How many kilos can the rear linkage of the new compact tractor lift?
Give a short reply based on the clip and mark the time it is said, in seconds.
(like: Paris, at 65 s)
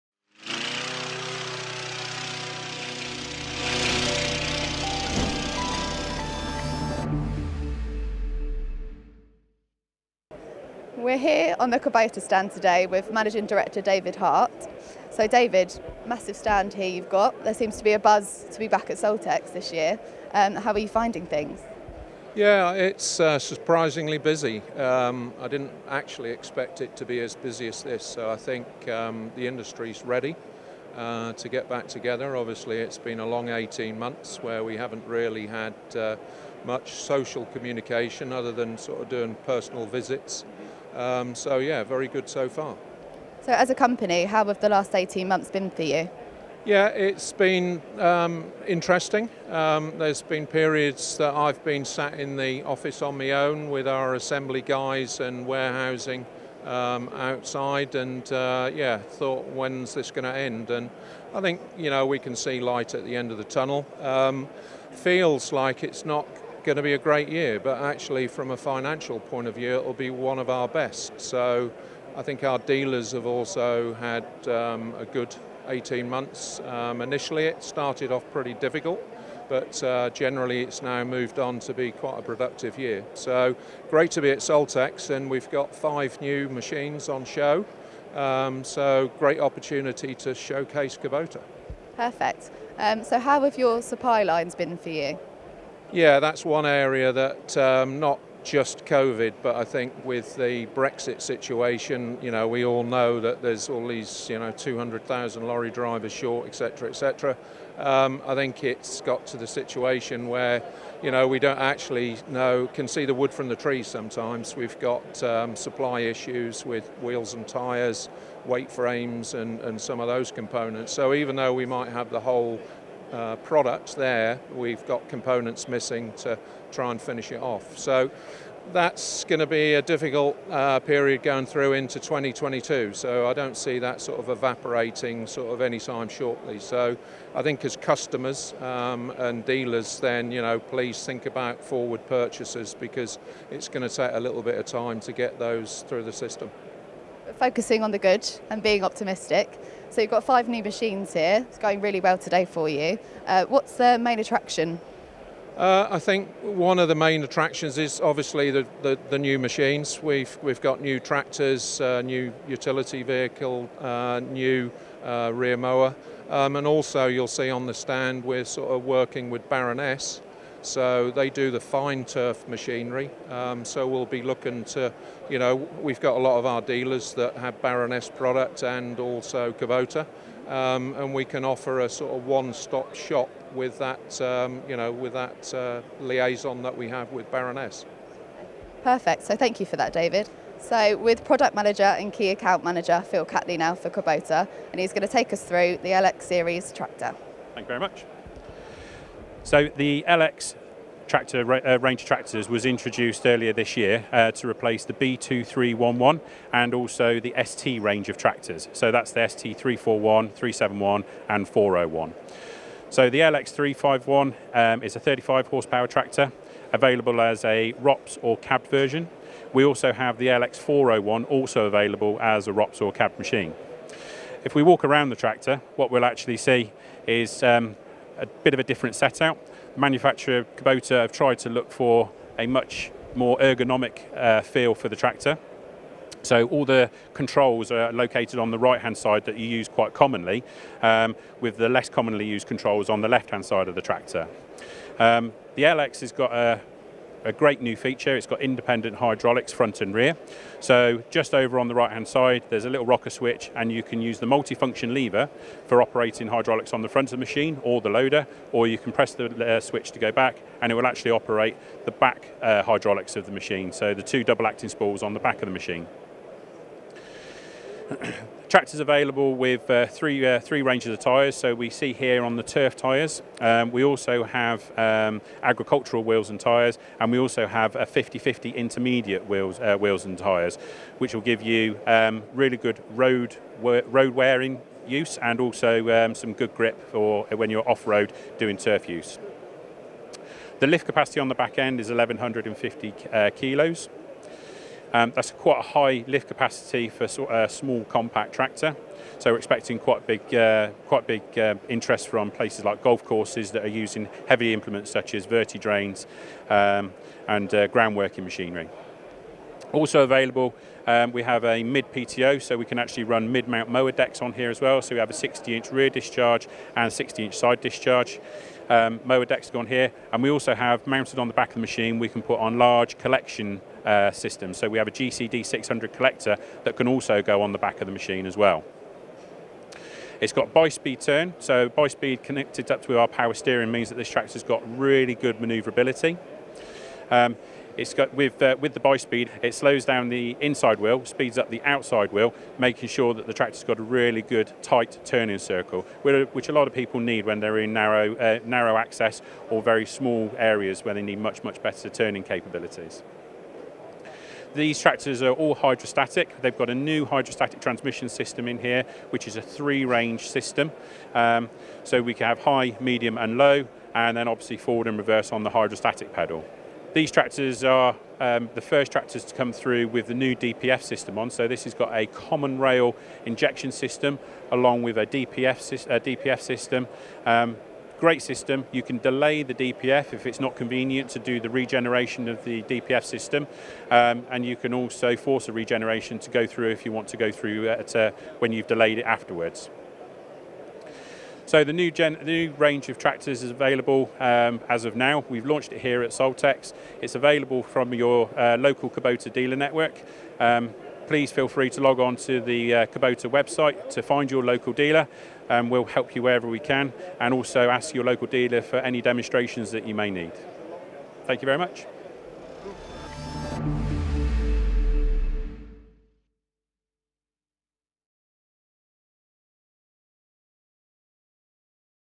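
1150 kilos, at 291 s.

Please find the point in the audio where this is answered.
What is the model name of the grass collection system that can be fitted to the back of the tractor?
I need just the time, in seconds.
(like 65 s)
324 s.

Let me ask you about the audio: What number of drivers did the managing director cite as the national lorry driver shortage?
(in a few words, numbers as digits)
200,000.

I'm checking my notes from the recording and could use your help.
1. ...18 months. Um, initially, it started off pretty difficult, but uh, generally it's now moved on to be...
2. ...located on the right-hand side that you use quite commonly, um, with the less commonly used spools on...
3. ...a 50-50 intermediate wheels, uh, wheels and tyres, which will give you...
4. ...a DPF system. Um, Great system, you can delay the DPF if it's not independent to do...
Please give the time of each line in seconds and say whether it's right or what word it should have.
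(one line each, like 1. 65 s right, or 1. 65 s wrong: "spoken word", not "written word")
1. 75 s right
2. 237 s wrong: "controls", not "spools"
3. 277 s right
4. 375 s wrong: "convenient", not "independent".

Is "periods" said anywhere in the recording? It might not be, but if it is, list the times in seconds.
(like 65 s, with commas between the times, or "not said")
50 s, 130 s.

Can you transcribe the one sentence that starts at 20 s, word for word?
Um, how are you finding things?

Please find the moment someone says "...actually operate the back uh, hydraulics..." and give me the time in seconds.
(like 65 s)
260 s.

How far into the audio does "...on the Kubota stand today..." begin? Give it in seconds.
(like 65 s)
11 s.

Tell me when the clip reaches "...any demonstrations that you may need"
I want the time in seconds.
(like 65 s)
408 s.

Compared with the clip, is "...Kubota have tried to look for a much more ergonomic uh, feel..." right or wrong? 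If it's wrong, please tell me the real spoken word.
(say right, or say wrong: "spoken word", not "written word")
right.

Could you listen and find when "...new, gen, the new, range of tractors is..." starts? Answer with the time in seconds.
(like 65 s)
391 s.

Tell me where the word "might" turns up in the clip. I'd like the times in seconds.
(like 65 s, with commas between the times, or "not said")
121 s.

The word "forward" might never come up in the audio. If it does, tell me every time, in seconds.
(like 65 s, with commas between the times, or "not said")
141 s, 364 s.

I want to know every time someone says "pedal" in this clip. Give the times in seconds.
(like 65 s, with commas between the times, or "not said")
366 s.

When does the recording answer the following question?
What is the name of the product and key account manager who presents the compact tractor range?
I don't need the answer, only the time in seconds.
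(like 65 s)
193 s.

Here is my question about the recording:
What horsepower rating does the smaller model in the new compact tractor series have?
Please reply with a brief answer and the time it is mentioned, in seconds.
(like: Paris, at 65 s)
35 horsepower, at 214 s.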